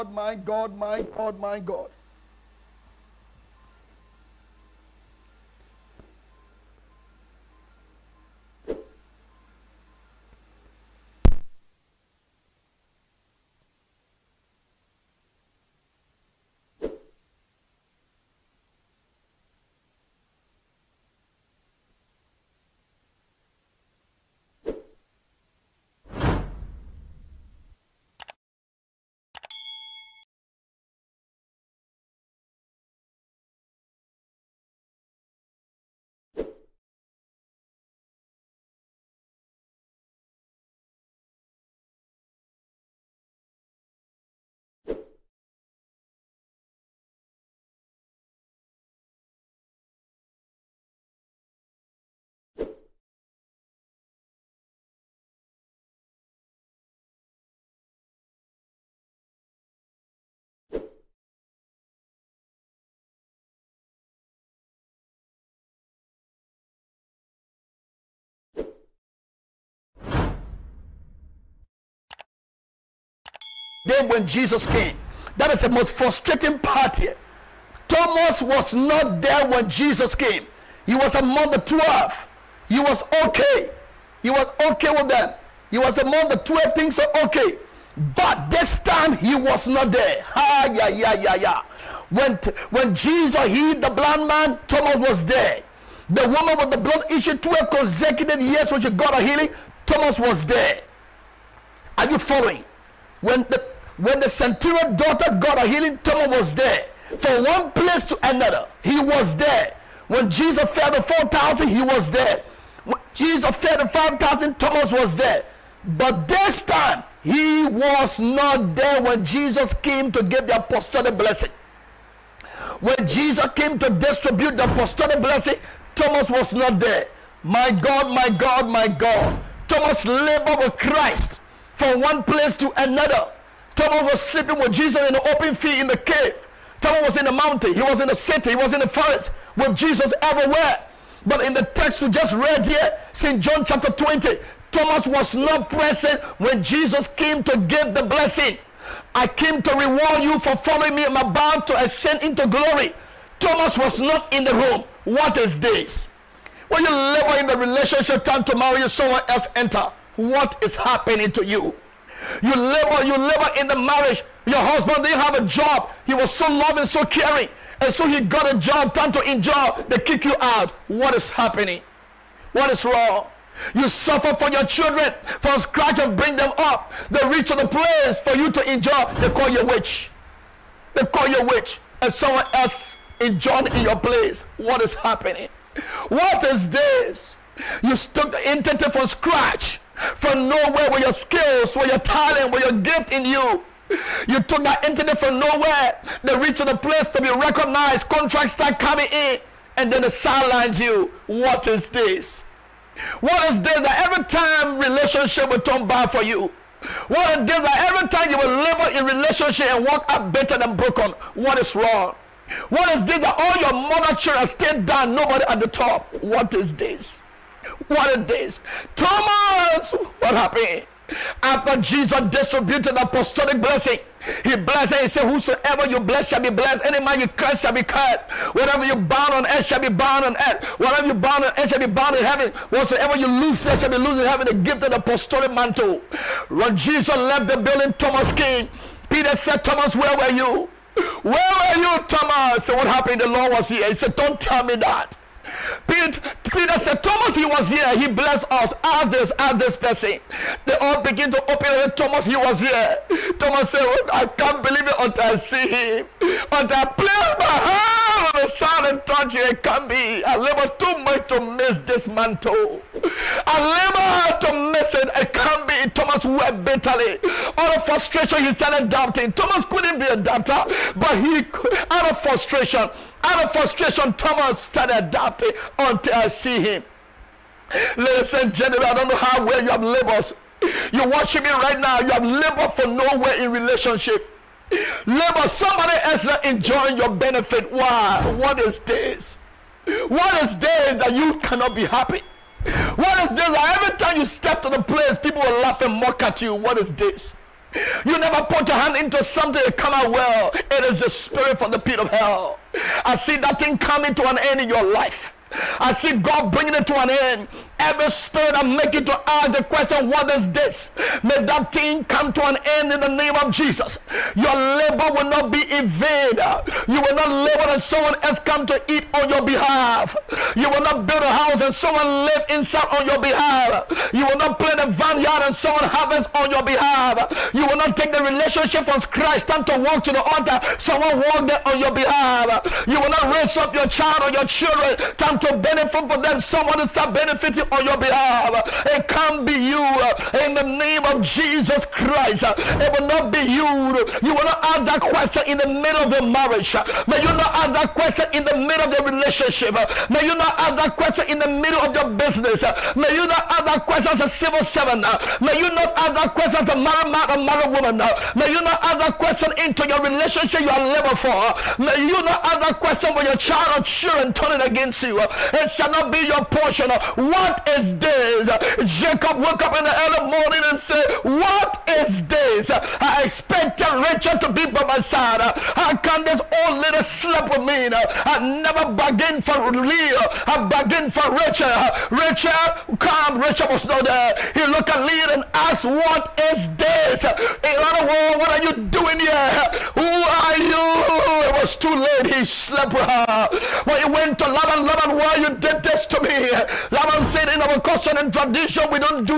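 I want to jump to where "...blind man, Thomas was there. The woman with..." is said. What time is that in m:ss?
1:33.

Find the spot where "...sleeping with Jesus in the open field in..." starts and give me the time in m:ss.
2:14.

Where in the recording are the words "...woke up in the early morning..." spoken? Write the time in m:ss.
6:09.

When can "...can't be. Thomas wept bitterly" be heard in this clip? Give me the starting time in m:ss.
4:25.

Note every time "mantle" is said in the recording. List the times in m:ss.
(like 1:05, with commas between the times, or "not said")
3:55, 4:22.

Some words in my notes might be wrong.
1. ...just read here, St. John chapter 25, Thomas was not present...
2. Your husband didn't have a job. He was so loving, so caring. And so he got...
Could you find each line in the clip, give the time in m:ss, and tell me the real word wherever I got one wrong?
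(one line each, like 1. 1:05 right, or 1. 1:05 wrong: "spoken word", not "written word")
1. 2:22 wrong: "20", not "25"
2. 2:44 right.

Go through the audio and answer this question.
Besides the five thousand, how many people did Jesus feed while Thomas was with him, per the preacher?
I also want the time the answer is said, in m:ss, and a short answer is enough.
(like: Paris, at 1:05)
4,000, at 1:51.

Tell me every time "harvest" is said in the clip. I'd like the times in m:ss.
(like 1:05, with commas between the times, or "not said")
5:25.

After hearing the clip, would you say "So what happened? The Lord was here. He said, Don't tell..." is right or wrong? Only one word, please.
right.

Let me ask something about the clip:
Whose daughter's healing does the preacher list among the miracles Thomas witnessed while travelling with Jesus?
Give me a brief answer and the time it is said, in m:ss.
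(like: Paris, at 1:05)
The centurion's, at 1:44.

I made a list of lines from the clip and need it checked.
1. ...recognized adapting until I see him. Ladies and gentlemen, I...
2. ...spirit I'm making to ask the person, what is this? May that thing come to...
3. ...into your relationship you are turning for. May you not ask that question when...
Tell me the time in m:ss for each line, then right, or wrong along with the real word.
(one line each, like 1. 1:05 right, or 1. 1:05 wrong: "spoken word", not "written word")
1. 4:34 wrong: "started", not "recognized"
2. 5:08 wrong: "question", not "person"
3. 5:59 wrong: "living", not "turning".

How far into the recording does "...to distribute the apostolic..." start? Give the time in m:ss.
2:03.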